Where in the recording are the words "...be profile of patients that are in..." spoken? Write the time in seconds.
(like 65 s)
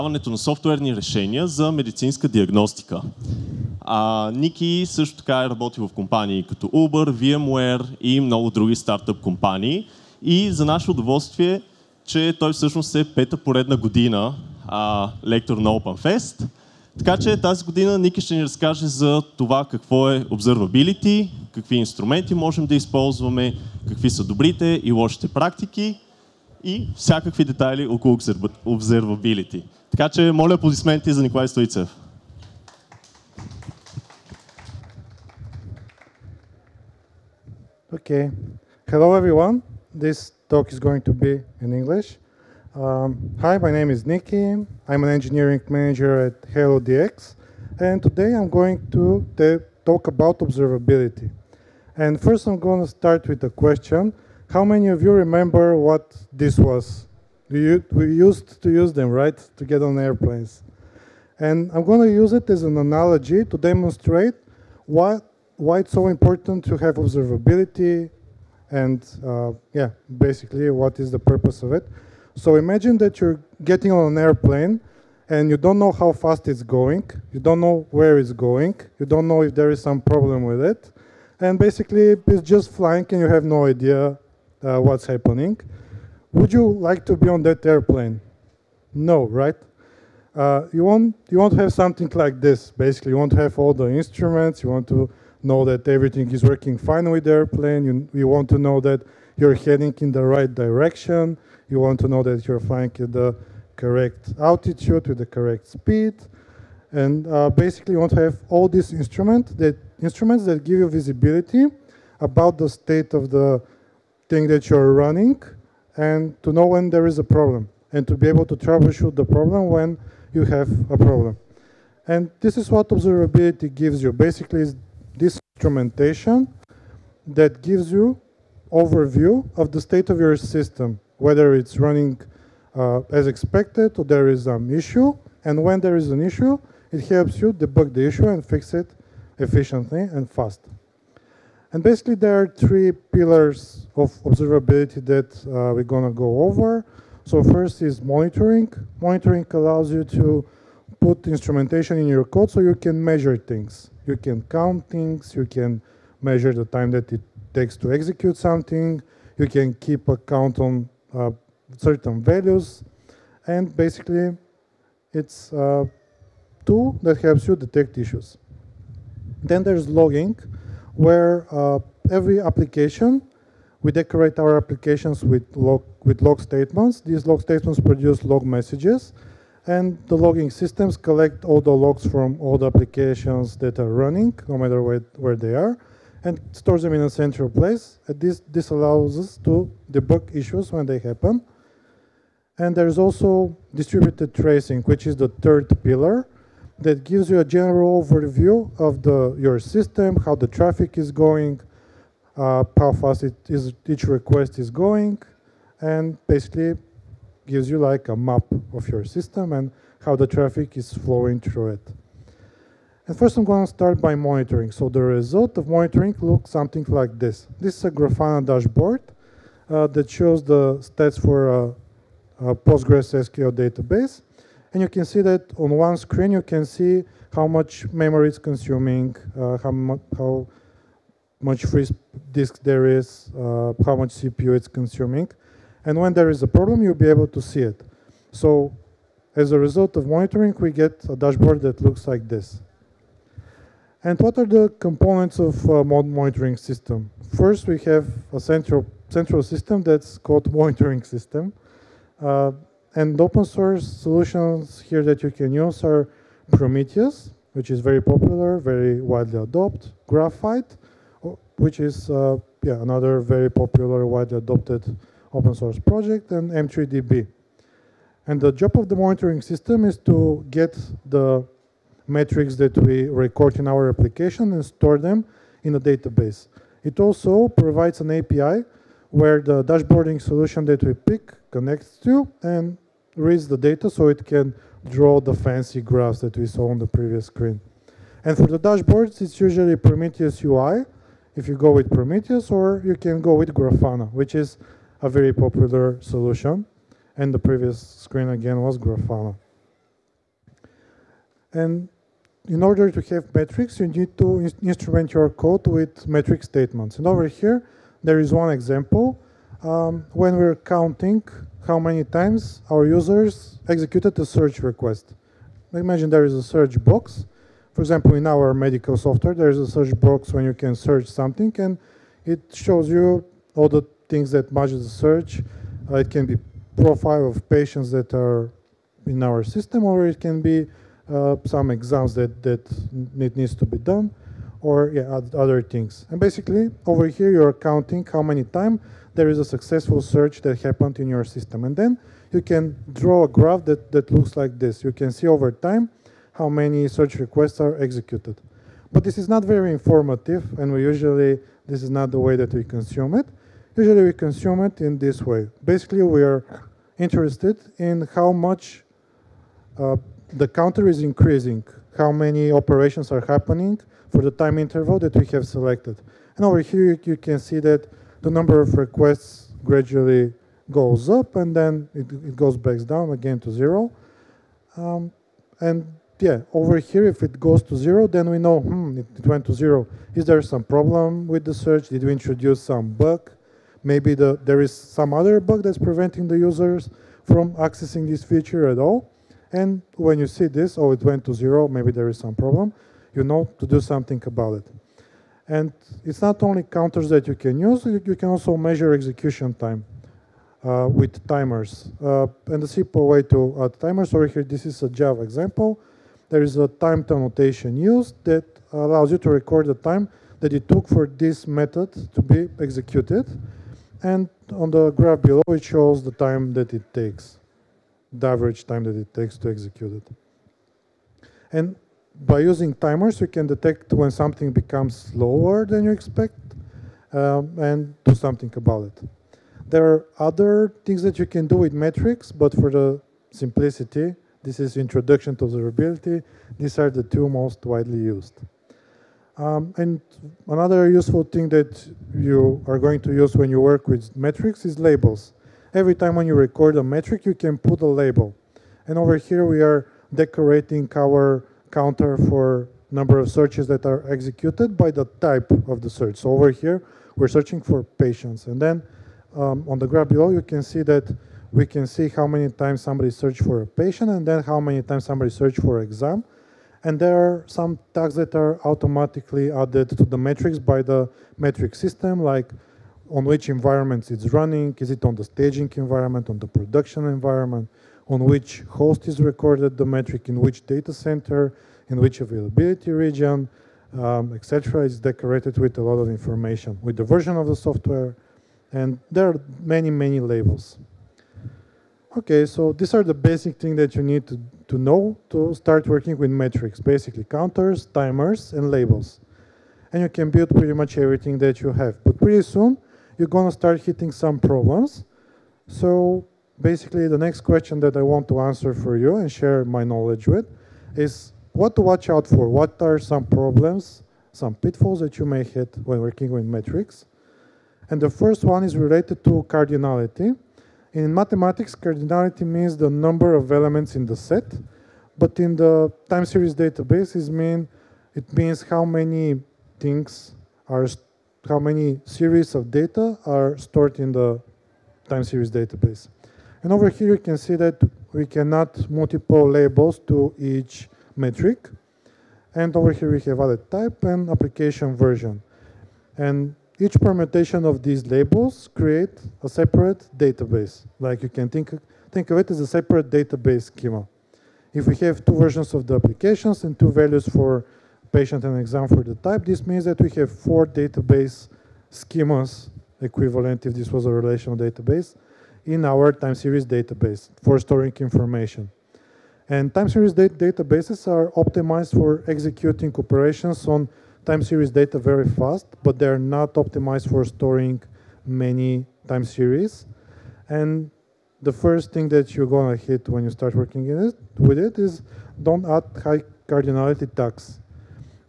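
326 s.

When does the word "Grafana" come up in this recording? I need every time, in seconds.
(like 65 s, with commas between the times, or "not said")
217 s, 293 s, 298 s.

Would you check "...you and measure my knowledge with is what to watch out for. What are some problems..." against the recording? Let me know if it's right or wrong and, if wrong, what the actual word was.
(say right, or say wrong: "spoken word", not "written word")
wrong: "share", not "measure".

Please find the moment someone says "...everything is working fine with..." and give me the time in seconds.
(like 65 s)
95 s.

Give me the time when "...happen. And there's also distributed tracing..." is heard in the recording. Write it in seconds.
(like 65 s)
190 s.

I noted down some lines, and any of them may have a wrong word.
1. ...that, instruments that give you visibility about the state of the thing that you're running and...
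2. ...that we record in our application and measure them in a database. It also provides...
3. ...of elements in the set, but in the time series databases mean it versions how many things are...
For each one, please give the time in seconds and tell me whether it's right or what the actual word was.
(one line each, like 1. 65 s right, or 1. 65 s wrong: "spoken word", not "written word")
1. 109 s right
2. 272 s wrong: "store", not "measure"
3. 523 s wrong: "means", not "versions".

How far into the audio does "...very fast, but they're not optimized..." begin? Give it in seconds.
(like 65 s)
574 s.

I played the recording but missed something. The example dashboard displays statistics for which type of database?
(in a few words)
Postgres SQL.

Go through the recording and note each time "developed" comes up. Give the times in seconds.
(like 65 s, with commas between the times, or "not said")
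not said.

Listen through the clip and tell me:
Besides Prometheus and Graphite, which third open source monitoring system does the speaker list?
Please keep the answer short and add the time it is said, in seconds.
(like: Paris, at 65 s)
M3DB, at 266 s.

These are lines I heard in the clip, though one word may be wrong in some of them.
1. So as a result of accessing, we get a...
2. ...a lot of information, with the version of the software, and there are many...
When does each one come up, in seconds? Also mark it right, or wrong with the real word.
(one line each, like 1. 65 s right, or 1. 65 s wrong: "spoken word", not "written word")
1. 238 s wrong: "monitoring", not "accessing"
2. 485 s right.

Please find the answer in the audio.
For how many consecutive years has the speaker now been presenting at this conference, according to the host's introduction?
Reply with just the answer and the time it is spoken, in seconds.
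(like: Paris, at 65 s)
5, at 13 s.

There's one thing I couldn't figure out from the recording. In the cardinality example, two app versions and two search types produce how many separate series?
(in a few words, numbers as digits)
4.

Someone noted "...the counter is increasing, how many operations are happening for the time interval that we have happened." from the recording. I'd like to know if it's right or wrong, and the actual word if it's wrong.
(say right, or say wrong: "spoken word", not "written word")
wrong: "selected", not "happened".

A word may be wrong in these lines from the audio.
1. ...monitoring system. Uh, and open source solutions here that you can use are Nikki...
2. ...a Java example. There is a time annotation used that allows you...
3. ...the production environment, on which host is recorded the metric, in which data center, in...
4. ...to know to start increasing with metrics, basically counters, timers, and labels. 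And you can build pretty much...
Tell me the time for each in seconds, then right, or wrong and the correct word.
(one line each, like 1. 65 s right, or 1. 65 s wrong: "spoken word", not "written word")
1. 250 s wrong: "Prometheus", not "Nikki"
2. 404 s right
3. 476 s right
4. 494 s wrong: "working", not "increasing".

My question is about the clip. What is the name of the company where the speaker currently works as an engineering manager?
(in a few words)
HealDX.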